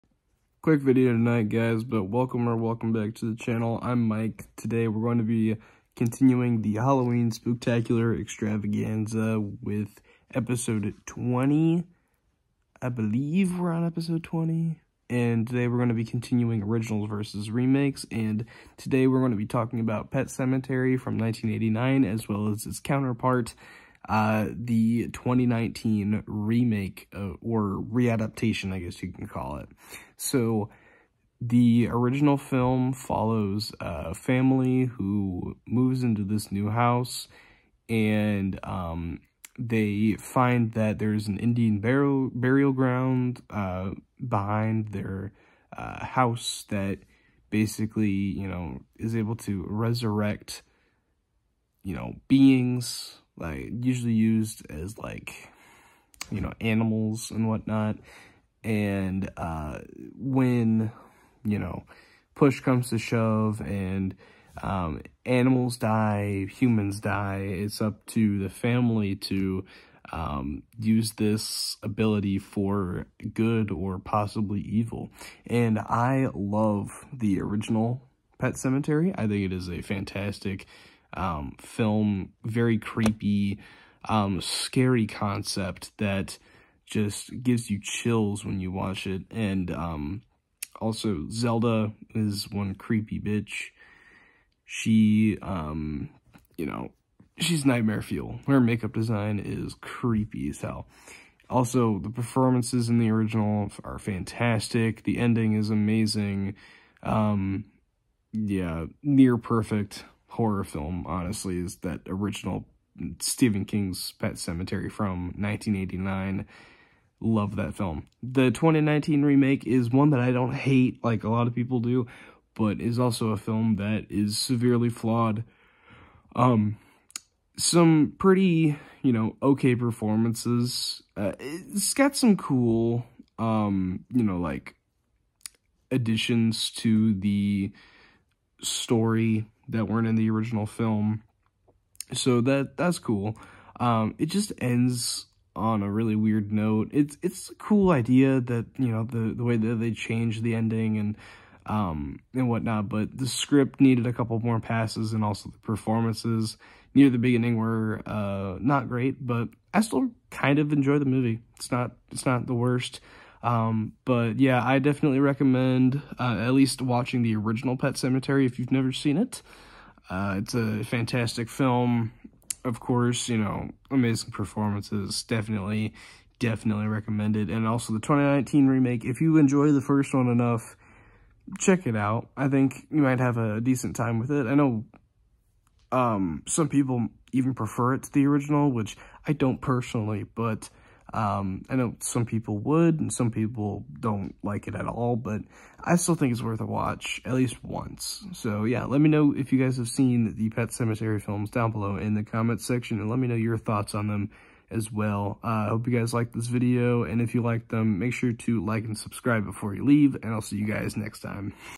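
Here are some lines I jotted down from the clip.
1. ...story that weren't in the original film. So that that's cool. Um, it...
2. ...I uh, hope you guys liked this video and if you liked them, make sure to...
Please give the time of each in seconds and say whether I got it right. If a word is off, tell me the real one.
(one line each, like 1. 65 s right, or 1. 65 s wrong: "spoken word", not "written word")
1. 138 s right
2. 205 s right.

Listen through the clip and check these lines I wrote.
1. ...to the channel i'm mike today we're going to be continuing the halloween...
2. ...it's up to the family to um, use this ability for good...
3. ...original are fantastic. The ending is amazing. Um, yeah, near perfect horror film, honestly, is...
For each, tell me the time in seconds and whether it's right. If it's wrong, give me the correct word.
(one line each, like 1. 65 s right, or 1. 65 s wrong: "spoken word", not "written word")
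1. 3 s right
2. 67 s right
3. 103 s right.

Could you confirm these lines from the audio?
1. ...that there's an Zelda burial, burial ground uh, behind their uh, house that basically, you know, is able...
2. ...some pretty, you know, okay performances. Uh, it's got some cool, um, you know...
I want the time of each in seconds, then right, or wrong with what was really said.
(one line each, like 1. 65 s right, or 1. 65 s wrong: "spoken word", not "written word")
1. 40 s wrong: "Indian", not "Zelda"
2. 127 s right.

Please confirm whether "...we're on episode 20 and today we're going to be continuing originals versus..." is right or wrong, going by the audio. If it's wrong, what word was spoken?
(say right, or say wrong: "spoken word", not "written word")
right.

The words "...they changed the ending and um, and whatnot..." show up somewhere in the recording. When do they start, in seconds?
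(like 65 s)
149 s.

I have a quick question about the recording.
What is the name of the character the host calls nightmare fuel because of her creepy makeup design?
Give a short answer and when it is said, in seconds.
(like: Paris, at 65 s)
Zelda, at 91 s.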